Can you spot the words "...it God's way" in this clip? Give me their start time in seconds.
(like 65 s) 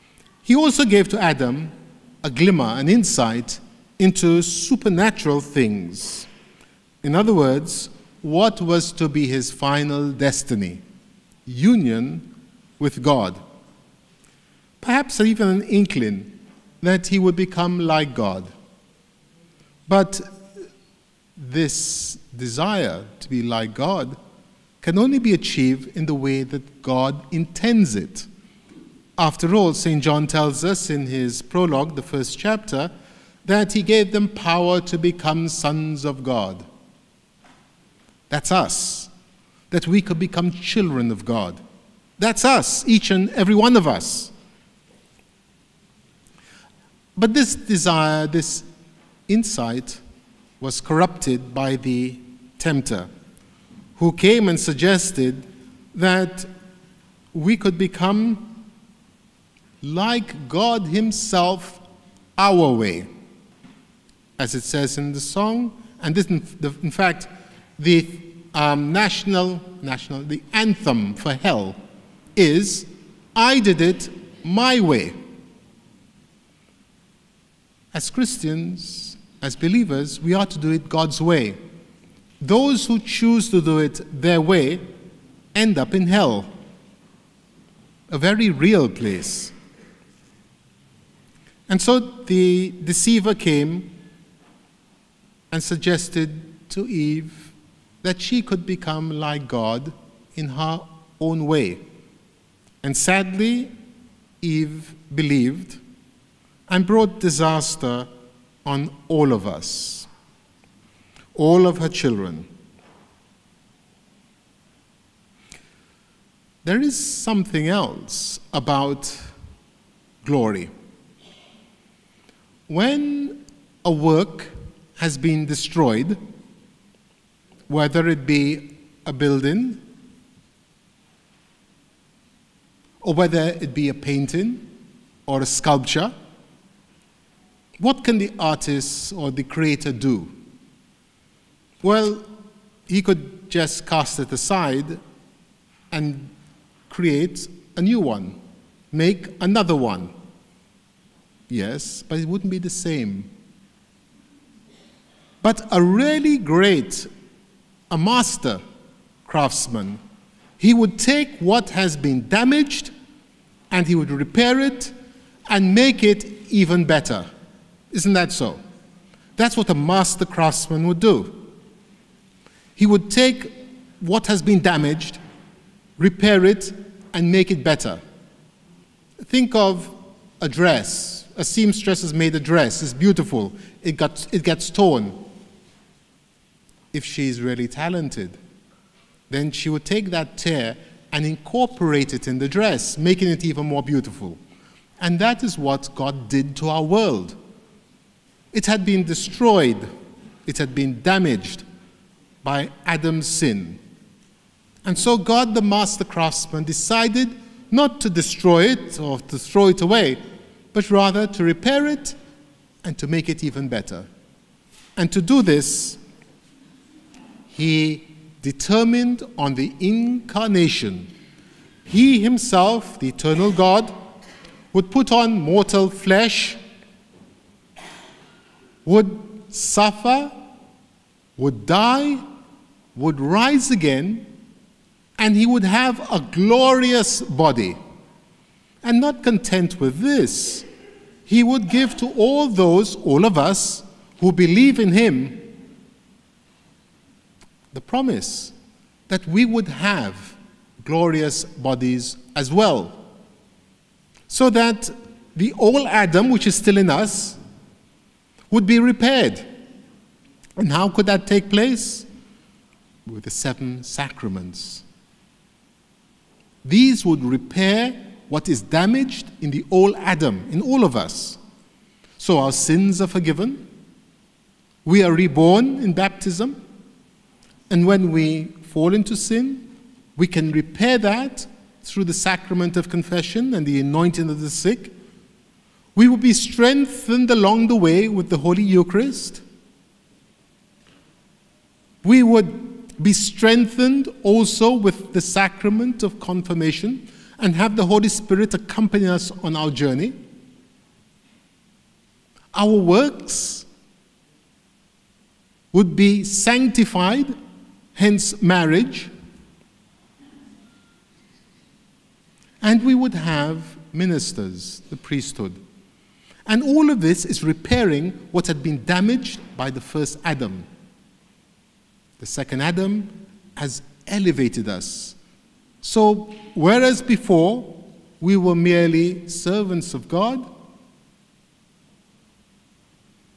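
80 s.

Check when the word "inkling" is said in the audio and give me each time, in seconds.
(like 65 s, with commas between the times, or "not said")
15 s.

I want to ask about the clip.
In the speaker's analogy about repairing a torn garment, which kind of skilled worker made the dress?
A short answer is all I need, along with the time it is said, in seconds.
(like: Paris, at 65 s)
A seamstress, at 181 s.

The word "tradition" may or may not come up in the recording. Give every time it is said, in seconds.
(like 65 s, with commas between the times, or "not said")
not said.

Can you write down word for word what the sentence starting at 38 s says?
That's us, that we could become children of God.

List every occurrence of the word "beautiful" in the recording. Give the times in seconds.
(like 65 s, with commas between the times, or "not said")
182 s, 193 s.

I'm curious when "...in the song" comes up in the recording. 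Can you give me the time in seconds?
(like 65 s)
64 s.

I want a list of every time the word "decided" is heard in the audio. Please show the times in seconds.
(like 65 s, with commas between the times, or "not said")
206 s.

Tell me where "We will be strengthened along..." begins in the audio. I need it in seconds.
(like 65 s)
285 s.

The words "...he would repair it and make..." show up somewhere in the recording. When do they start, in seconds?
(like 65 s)
163 s.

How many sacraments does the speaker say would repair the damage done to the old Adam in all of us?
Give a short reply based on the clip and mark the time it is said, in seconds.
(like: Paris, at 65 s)
7, at 263 s.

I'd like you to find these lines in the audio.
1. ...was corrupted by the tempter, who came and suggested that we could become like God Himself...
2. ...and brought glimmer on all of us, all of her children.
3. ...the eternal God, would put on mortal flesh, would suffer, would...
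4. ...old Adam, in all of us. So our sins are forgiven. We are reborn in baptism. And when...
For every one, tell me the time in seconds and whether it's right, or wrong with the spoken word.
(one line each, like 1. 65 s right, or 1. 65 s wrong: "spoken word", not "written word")
1. 50 s right
2. 106 s wrong: "disaster", not "glimmer"
3. 223 s right
4. 269 s right.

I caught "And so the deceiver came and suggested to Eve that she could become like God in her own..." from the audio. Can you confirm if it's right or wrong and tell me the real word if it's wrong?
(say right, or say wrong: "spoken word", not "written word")
right.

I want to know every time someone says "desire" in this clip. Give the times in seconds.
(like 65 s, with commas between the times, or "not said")
22 s, 47 s.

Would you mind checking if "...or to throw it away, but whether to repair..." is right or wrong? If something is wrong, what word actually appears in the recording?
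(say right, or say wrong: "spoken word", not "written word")
wrong: "rather", not "whether".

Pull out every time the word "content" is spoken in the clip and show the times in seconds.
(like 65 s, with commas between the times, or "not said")
239 s.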